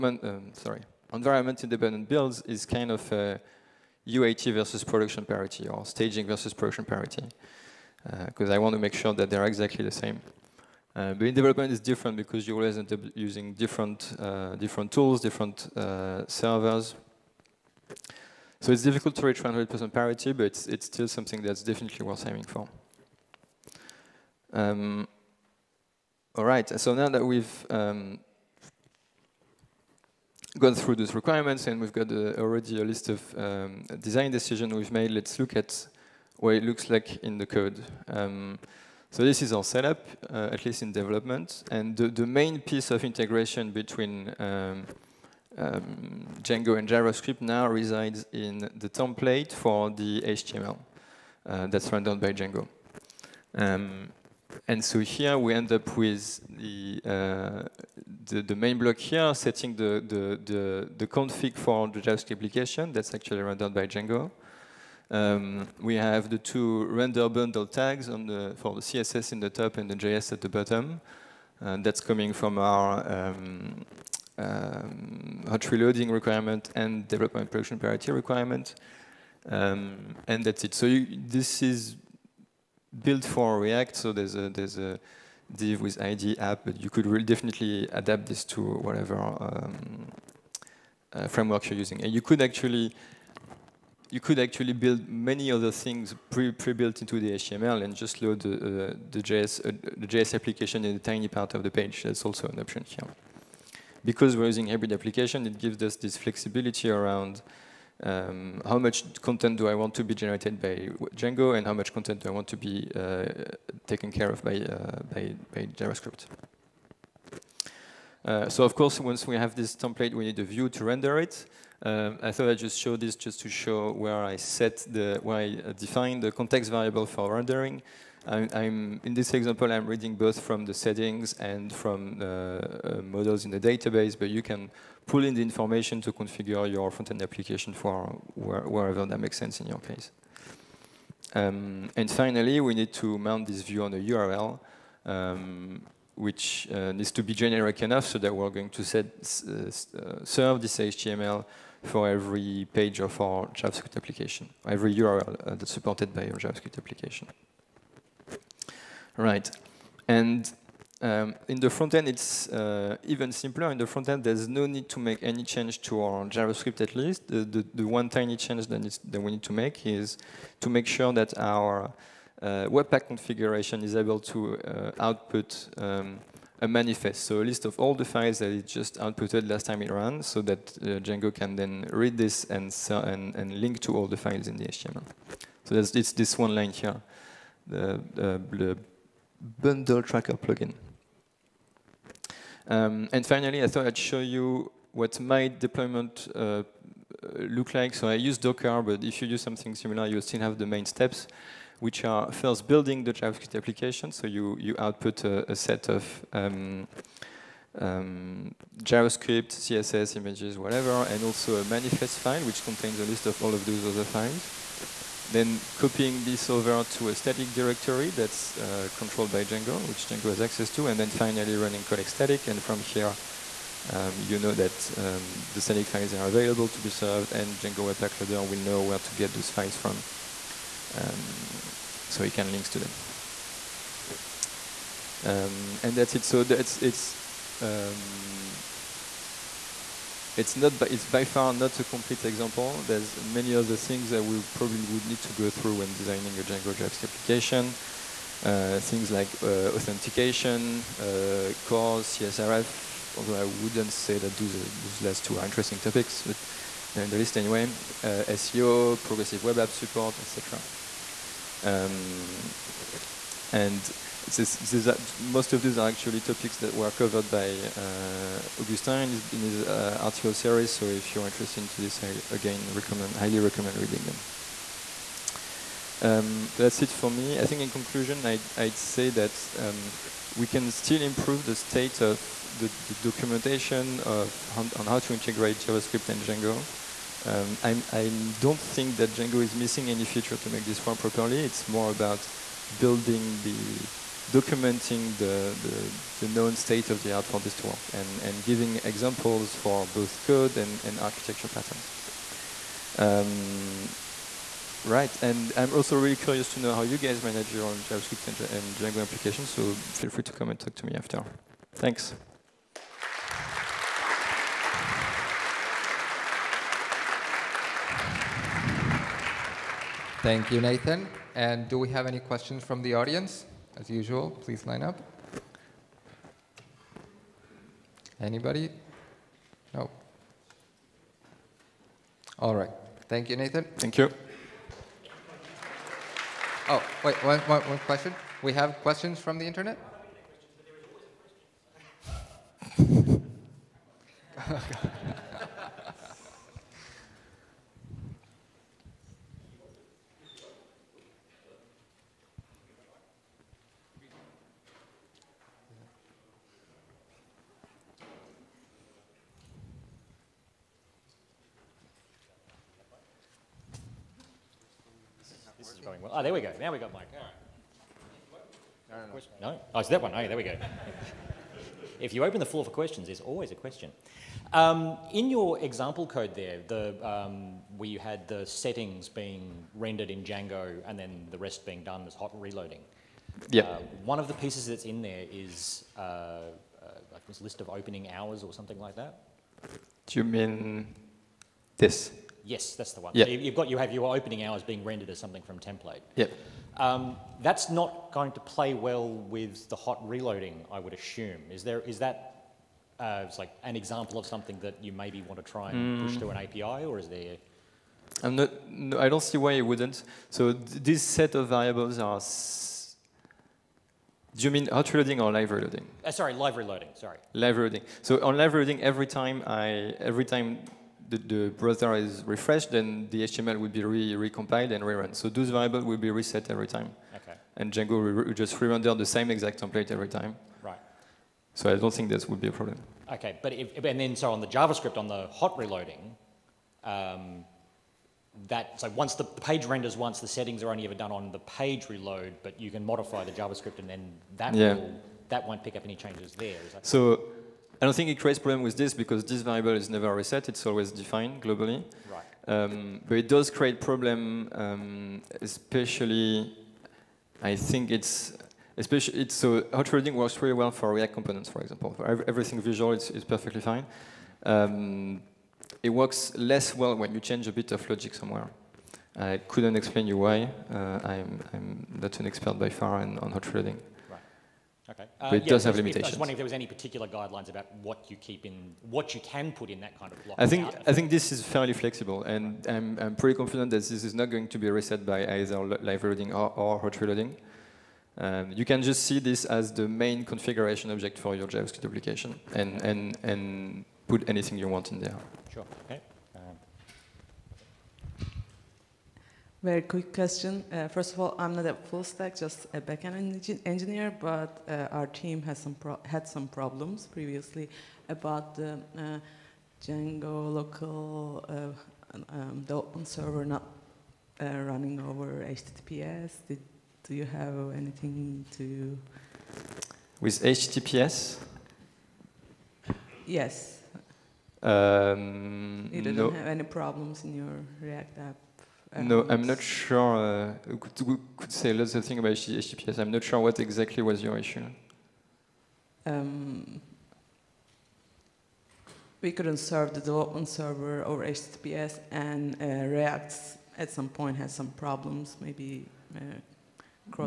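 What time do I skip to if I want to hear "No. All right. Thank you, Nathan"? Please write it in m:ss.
5:29.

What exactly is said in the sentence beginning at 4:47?
Um, I don't think that Django is missing any feature to make this work properly.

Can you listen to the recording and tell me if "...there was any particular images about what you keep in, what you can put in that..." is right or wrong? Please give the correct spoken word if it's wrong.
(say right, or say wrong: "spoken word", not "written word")
wrong: "guidelines", not "images".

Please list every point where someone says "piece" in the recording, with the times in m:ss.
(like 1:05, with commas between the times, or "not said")
0:42, 6:24.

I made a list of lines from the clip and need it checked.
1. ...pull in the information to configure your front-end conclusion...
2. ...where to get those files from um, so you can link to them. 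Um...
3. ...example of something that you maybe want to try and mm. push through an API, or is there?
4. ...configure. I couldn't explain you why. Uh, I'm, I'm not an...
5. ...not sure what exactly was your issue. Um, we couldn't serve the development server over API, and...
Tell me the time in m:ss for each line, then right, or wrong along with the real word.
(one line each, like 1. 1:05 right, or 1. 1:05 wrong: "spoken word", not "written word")
1. 2:15 wrong: "application", not "conclusion"
2. 3:48 right
3. 6:43 right
4. 7:48 wrong: "somewhere", not "configure"
5. 8:53 wrong: "HTTPS", not "API".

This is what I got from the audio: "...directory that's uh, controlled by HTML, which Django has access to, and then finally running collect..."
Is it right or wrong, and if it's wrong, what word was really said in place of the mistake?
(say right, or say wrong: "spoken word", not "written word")
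wrong: "Django", not "HTML".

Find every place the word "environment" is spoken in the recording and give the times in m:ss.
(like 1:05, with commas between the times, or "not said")
0:01.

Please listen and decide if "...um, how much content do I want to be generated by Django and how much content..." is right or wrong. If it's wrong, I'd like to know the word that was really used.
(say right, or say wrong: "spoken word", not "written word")
right.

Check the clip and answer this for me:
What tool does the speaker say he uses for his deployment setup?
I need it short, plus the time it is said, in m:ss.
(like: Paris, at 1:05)
Docker, at 3:17.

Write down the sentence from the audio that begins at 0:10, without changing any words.
Uh, but in development, it's different because you always end up using different, uh, different tools, different uh, servers.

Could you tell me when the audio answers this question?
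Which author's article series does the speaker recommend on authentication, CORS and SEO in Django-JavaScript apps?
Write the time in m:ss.
4:28.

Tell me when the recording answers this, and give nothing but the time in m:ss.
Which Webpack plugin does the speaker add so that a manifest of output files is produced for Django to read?
3:08.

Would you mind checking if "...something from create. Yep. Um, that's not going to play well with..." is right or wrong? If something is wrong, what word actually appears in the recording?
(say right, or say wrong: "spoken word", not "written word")
wrong: "template", not "create".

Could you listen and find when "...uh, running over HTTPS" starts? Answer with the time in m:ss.
8:34.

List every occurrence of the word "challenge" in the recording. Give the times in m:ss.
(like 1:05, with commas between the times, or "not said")
not said.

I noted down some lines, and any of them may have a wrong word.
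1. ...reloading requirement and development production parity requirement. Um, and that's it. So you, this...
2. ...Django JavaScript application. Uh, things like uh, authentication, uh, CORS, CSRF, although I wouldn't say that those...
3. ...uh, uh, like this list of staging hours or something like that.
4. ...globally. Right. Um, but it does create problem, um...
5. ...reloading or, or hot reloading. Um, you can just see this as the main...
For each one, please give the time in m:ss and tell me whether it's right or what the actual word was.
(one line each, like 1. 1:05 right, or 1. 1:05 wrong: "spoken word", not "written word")
1. 1:15 right
2. 4:06 right
3. 6:25 wrong: "opening", not "staging"
4. 7:31 right
5. 8:06 right.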